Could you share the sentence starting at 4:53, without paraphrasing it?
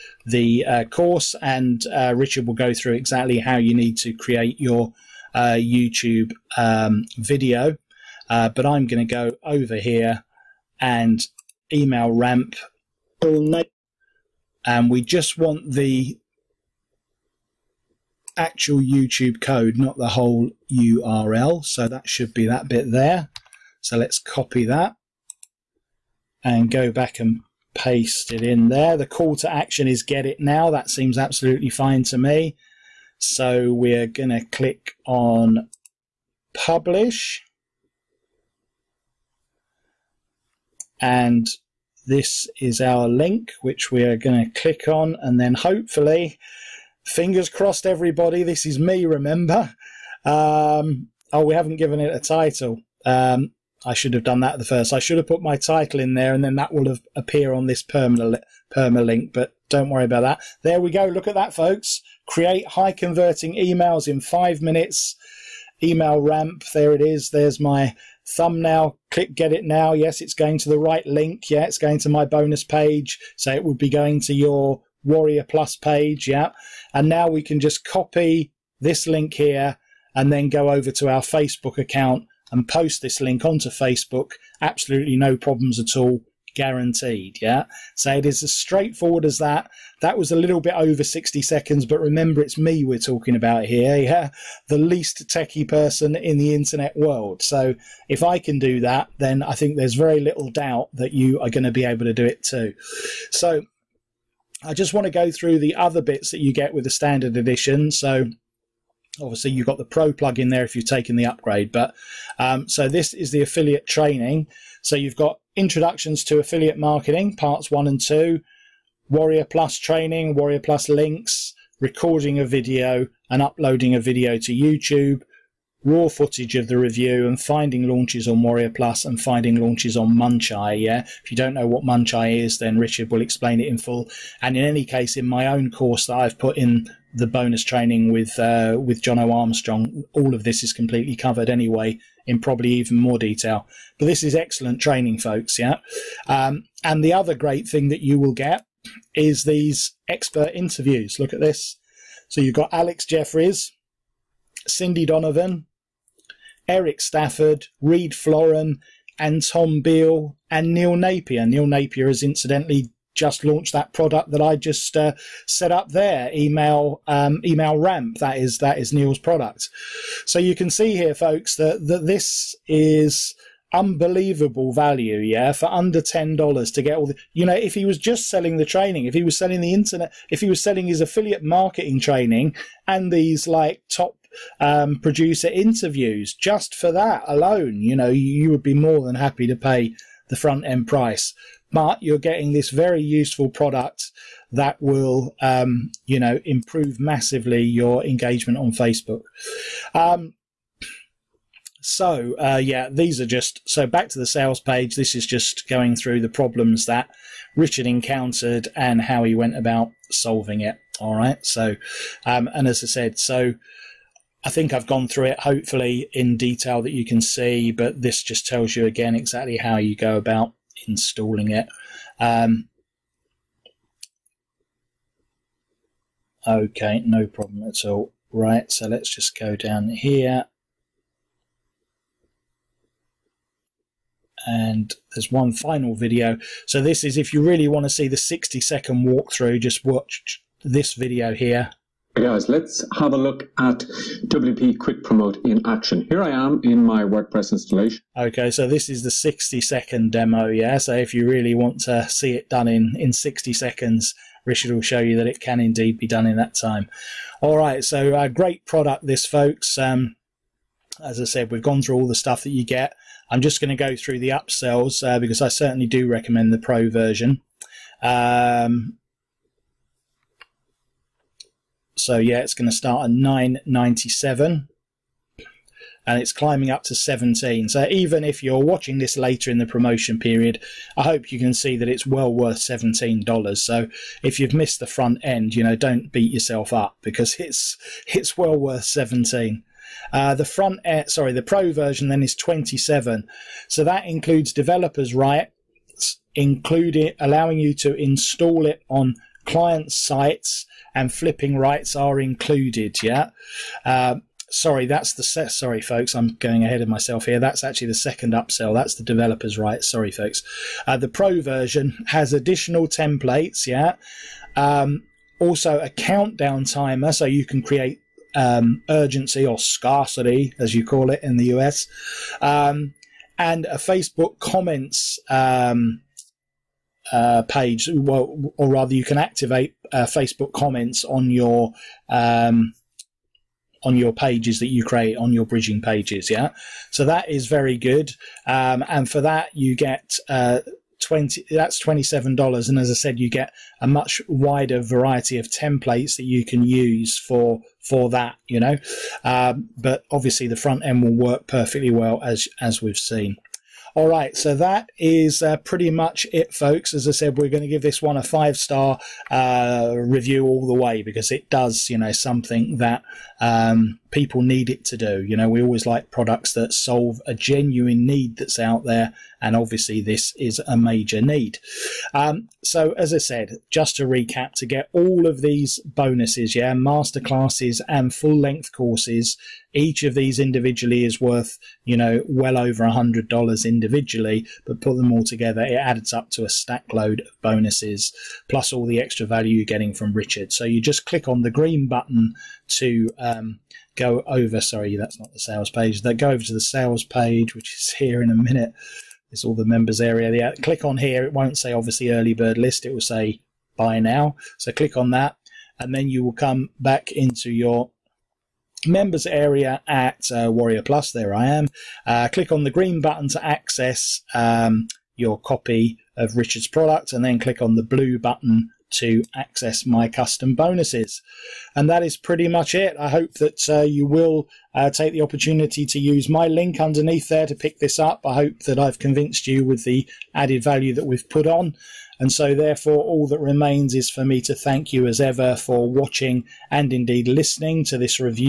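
So that includes developers' rights, including allowing you to install it on client sites and flipping rights are included.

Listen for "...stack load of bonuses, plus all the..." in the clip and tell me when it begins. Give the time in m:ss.
6:26.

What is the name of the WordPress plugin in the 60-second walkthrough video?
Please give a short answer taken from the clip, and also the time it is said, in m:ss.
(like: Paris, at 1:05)
WP Quick Promote, at 4:04.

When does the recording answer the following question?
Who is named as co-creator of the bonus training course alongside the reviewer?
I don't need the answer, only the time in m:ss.
2:19.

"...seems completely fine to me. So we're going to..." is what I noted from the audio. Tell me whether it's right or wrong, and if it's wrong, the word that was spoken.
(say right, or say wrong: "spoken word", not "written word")
wrong: "absolutely", not "completely".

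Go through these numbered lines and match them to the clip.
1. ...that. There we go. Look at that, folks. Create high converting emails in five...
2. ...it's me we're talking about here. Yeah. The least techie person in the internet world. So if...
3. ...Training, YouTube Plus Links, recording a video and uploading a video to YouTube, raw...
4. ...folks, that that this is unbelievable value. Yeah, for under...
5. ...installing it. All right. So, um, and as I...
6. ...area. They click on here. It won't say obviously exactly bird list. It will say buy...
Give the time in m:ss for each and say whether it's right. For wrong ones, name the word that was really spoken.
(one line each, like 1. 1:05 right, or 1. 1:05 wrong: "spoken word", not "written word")
1. 1:00 right
2. 1:32 right
3. 1:59 wrong: "Warrior", not "YouTube"
4. 2:51 right
5. 3:30 wrong: "solving", not "installing"
6. 6:40 wrong: "early", not "exactly".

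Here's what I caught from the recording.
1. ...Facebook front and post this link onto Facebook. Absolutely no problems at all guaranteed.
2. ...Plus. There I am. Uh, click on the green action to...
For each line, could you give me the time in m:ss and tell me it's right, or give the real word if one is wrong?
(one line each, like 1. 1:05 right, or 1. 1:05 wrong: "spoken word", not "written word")
1. 1:21 wrong: "account", not "front"
2. 6:50 wrong: "button", not "action".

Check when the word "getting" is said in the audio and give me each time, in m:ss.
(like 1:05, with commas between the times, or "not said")
3:12, 6:29.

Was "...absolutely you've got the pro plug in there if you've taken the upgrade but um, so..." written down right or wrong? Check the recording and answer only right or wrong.
wrong.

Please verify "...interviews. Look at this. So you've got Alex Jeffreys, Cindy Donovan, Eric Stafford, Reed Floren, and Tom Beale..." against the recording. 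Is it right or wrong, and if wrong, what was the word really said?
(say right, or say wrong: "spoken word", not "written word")
right.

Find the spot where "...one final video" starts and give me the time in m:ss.
3:55.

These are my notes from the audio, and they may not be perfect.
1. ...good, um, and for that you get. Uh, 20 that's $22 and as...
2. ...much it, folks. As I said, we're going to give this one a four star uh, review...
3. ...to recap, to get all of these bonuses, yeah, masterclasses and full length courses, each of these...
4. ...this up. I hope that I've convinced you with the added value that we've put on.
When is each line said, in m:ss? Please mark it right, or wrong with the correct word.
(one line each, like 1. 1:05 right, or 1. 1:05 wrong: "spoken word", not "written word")
1. 5:37 wrong: "27", not "22"
2. 5:55 wrong: "five", not "four"
3. 6:13 right
4. 7:07 right.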